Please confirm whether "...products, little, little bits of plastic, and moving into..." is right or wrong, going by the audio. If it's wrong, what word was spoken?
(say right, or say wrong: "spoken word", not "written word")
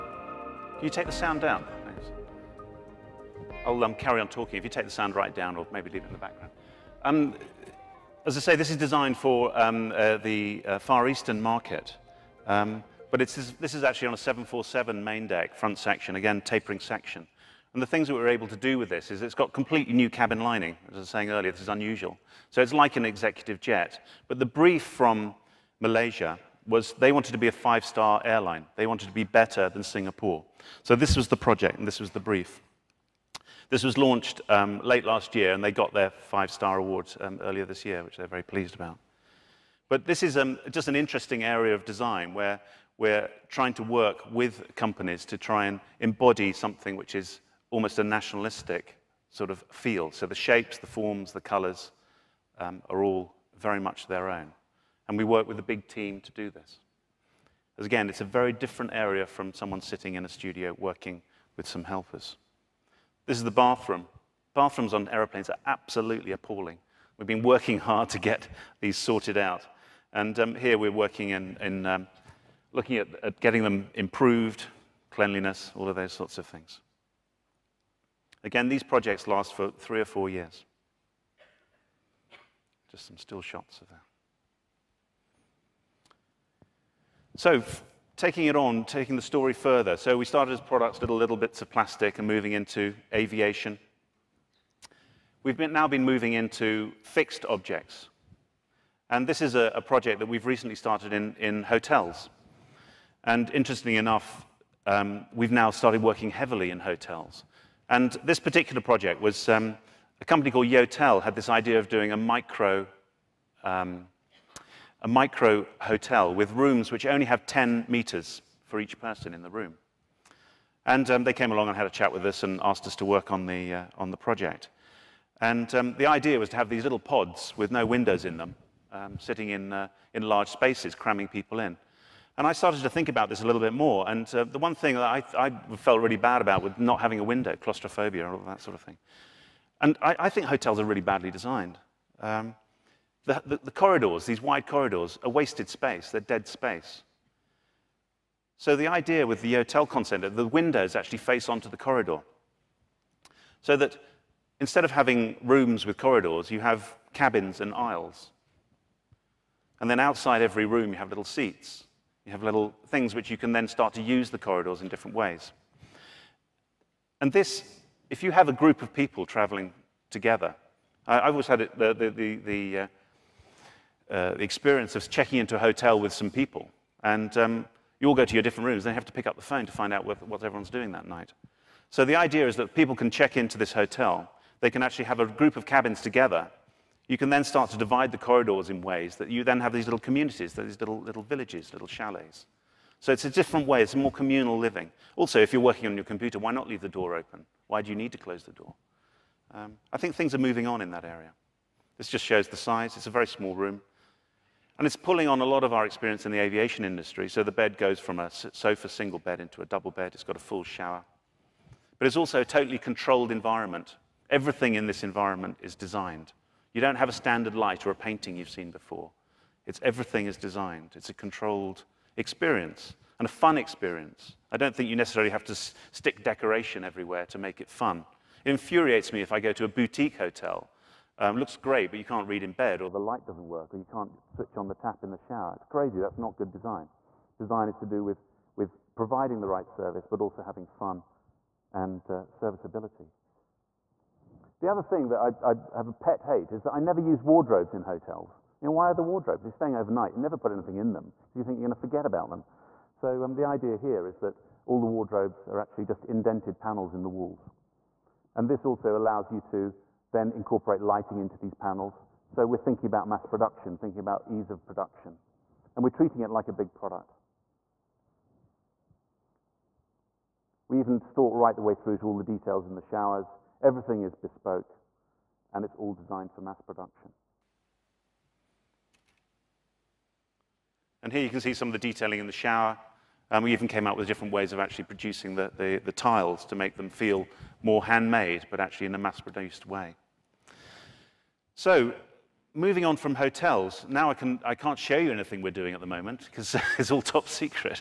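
right.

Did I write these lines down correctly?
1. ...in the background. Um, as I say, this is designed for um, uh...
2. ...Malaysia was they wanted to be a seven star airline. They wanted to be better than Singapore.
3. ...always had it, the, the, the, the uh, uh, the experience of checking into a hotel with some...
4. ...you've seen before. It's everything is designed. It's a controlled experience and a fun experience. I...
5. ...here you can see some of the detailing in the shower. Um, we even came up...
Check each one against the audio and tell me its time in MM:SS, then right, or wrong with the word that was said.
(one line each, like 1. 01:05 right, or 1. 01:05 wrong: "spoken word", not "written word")
1. 00:06 right
2. 00:25 wrong: "five", not "seven"
3. 02:51 right
4. 03:38 right
5. 04:41 right.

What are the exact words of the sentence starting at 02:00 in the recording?
And um, they came along and had a chat with us and asked us to work on the, uh, on the project.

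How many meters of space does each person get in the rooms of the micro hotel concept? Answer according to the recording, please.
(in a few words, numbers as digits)
10 meters.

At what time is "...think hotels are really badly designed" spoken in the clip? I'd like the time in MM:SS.
02:20.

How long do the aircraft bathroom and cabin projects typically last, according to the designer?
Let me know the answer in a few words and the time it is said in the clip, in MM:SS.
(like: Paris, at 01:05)
3 or 4 years, at 01:19.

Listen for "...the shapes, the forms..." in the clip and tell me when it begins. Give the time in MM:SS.
00:50.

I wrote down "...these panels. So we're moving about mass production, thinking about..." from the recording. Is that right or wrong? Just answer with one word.
wrong.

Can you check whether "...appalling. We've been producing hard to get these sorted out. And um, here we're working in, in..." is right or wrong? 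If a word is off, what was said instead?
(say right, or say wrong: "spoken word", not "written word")
wrong: "working", not "producing".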